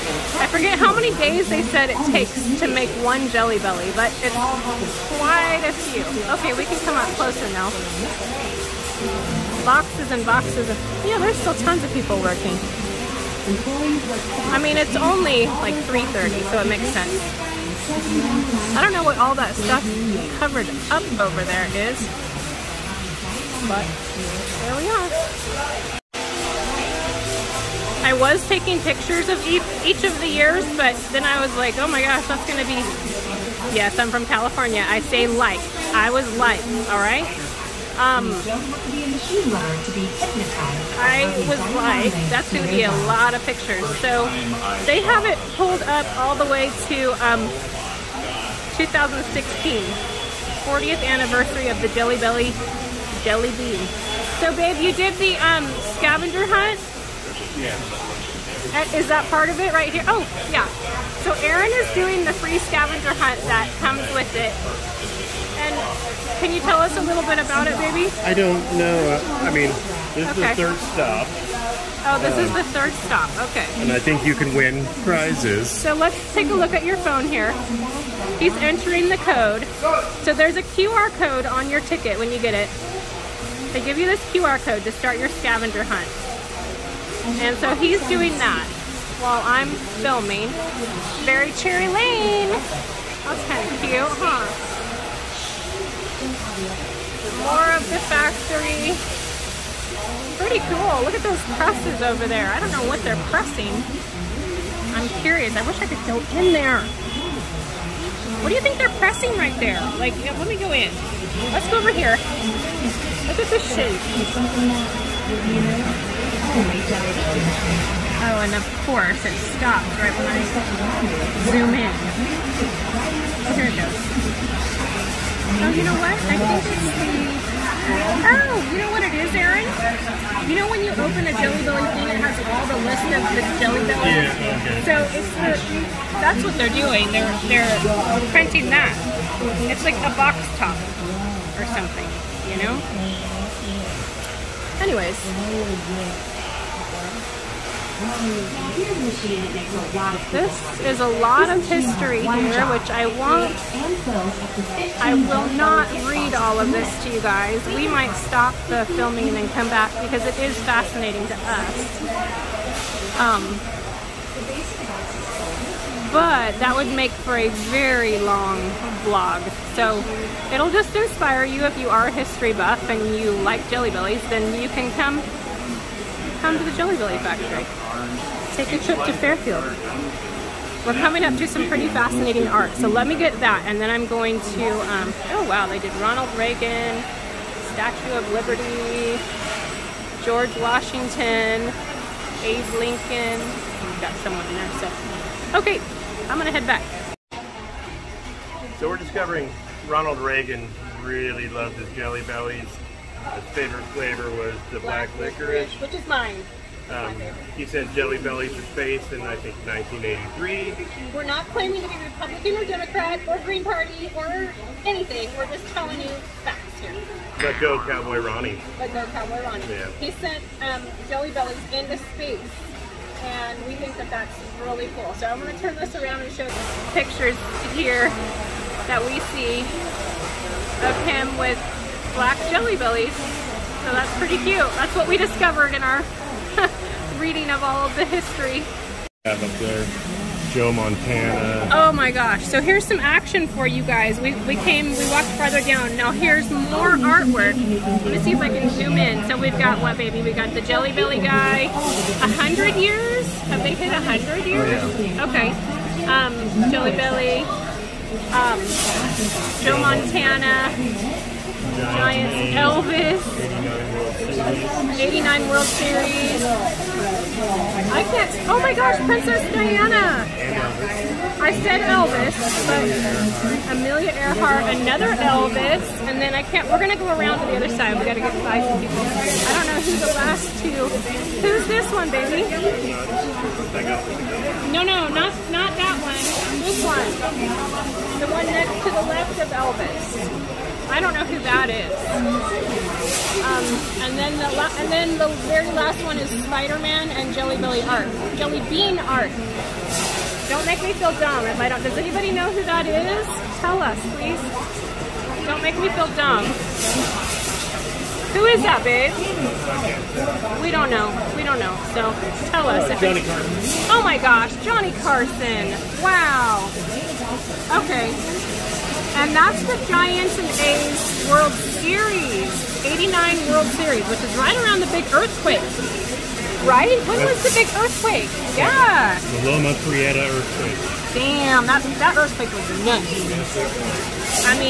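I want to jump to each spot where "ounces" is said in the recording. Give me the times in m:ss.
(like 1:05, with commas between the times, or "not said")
not said.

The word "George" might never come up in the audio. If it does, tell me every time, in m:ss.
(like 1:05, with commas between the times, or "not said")
3:10.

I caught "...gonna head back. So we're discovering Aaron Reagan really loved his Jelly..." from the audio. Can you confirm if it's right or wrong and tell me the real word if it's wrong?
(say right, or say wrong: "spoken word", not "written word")
wrong: "Ronald", not "Aaron".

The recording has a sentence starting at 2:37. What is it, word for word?
We might stop the filming and then come back because it is fascinating to us.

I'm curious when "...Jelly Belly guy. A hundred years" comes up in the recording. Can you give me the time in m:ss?
4:10.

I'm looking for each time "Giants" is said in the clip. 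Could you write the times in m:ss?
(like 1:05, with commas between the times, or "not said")
4:21, 5:19.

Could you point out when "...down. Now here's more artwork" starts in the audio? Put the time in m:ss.
4:05.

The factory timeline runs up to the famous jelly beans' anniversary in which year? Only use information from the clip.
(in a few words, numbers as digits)
2016.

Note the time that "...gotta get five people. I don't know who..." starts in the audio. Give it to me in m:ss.
4:38.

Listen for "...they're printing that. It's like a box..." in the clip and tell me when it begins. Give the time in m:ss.
2:17.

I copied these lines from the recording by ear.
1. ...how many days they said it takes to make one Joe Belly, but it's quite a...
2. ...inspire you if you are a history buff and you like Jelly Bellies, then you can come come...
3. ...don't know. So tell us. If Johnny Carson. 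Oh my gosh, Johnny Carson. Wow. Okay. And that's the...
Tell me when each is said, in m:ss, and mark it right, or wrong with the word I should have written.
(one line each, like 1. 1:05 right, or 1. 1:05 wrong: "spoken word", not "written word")
1. 0:00 wrong: "Jelly", not "Joe"
2. 2:50 right
3. 5:11 right.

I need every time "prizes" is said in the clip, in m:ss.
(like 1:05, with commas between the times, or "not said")
1:15.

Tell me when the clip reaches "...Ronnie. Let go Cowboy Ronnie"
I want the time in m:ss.
3:38.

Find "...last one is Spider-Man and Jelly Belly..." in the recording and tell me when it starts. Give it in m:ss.
4:55.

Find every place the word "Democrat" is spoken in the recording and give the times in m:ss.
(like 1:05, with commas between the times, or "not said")
3:32.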